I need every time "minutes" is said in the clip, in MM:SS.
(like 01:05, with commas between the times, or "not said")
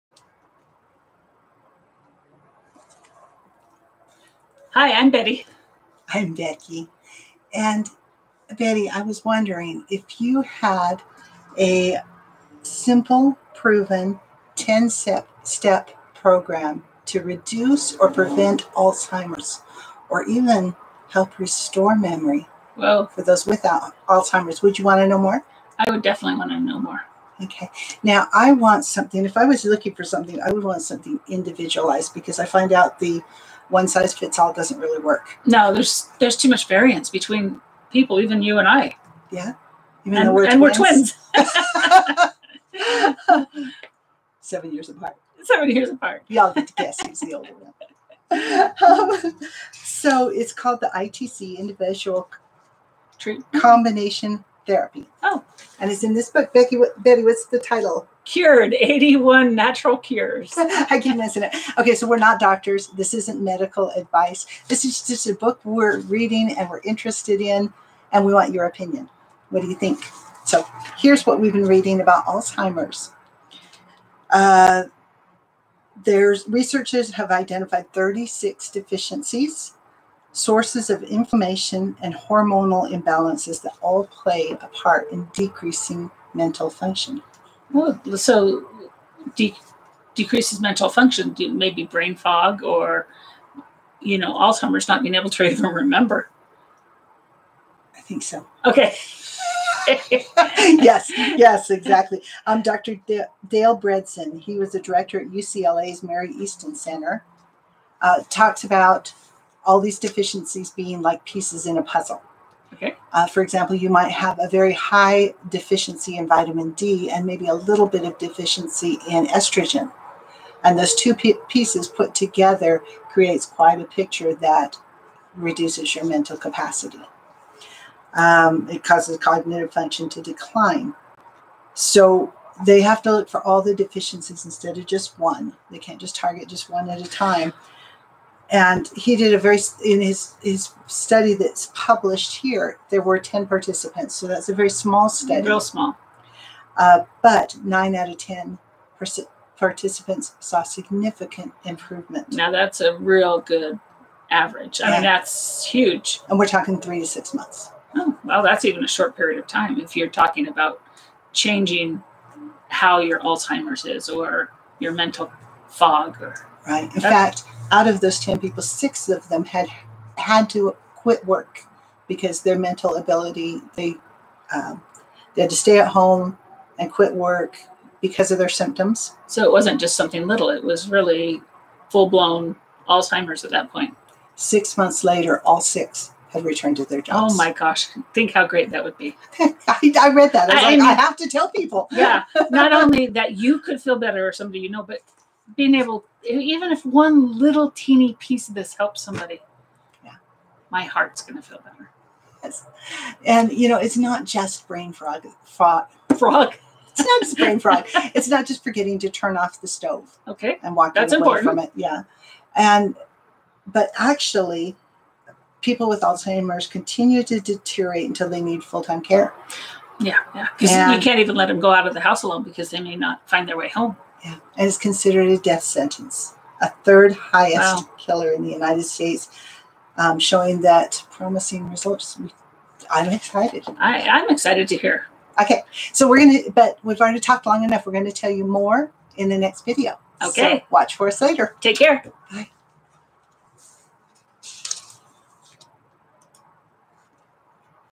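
not said.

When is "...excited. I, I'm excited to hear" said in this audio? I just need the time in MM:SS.
03:53.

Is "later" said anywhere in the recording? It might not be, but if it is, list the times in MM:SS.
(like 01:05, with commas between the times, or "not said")
03:05, 04:01.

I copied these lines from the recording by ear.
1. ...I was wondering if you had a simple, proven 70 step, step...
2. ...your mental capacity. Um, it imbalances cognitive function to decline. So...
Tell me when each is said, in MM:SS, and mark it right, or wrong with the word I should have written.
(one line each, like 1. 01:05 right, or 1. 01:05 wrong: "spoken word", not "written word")
1. 00:08 wrong: "10", not "70"
2. 02:05 wrong: "causes", not "imbalances".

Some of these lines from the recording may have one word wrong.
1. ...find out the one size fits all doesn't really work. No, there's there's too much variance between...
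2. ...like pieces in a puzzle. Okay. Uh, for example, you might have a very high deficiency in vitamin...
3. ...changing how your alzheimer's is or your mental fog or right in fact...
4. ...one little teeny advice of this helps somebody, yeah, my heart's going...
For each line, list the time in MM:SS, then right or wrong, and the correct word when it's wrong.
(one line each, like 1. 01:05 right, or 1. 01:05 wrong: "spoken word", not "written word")
1. 00:32 right
2. 01:51 right
3. 02:41 right
4. 03:16 wrong: "piece", not "advice".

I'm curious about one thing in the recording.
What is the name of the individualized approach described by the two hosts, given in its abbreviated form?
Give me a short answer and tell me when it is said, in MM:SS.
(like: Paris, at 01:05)
ITC, at 00:50.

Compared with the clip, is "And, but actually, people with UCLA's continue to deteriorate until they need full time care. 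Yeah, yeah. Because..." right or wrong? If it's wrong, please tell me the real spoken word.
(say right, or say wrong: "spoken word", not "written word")
wrong: "Alzheimer", not "UCLA".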